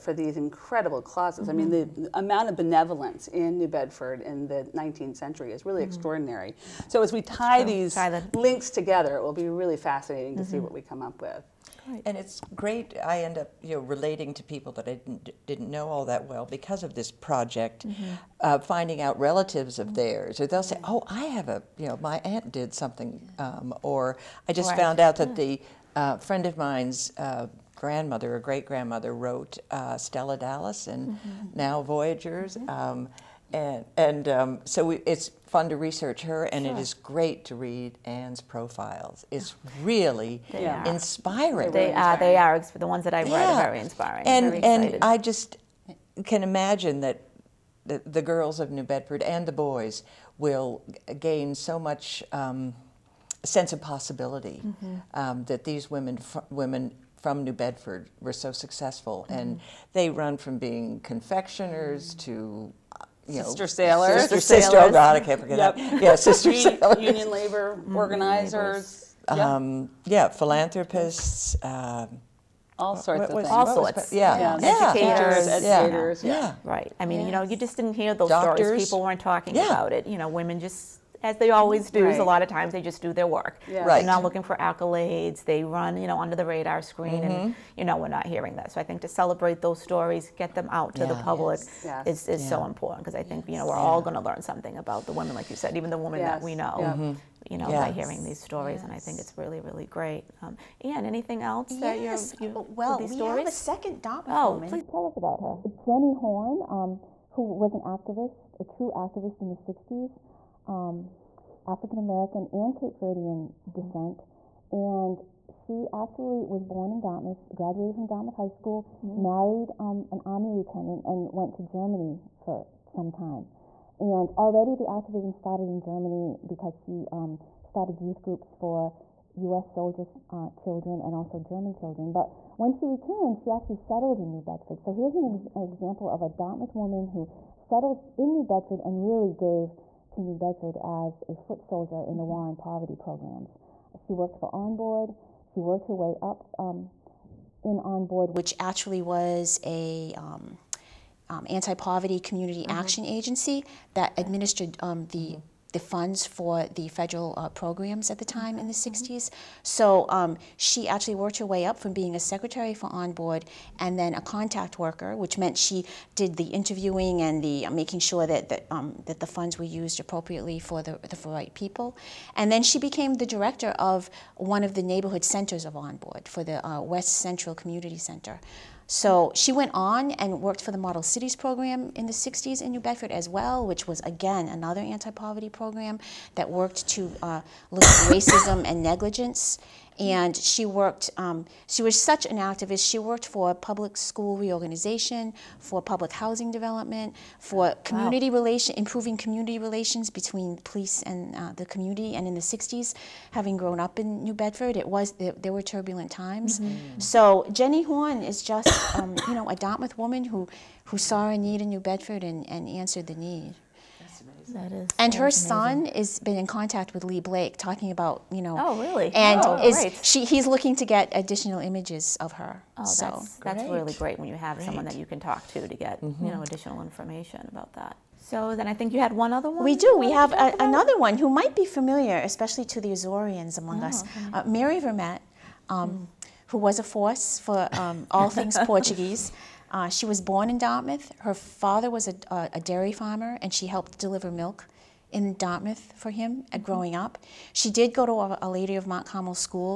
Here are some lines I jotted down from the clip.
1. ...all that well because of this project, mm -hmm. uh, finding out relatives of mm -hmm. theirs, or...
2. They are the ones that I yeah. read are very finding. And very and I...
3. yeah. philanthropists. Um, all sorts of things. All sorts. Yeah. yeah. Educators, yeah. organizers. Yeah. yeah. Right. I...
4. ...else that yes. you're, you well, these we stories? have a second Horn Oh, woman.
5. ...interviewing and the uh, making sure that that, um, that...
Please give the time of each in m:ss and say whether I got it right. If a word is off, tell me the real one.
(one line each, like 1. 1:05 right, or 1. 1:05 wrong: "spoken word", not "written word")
1. 0:15 right
2. 0:42 wrong: "inspiring", not "finding"
3. 1:10 wrong: "educators", not "organizers"
4. 1:41 wrong: "Dom", not "Horn"
5. 2:46 right.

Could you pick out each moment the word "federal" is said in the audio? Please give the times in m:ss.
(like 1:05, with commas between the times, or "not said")
2:36.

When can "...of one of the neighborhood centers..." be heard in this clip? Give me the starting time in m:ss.
2:53.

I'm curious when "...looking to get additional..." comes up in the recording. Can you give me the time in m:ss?
3:40.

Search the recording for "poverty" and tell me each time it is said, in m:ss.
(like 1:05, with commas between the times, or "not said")
2:22, 2:31, 3:05.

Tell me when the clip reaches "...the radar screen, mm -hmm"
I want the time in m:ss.
1:26.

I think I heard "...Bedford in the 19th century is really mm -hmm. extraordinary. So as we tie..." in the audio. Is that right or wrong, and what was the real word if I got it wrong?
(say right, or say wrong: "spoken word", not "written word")
right.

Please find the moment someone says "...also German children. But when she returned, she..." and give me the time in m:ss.
2:11.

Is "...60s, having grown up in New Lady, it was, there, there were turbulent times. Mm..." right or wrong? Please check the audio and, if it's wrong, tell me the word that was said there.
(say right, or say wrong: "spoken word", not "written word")
wrong: "Bedford", not "Lady".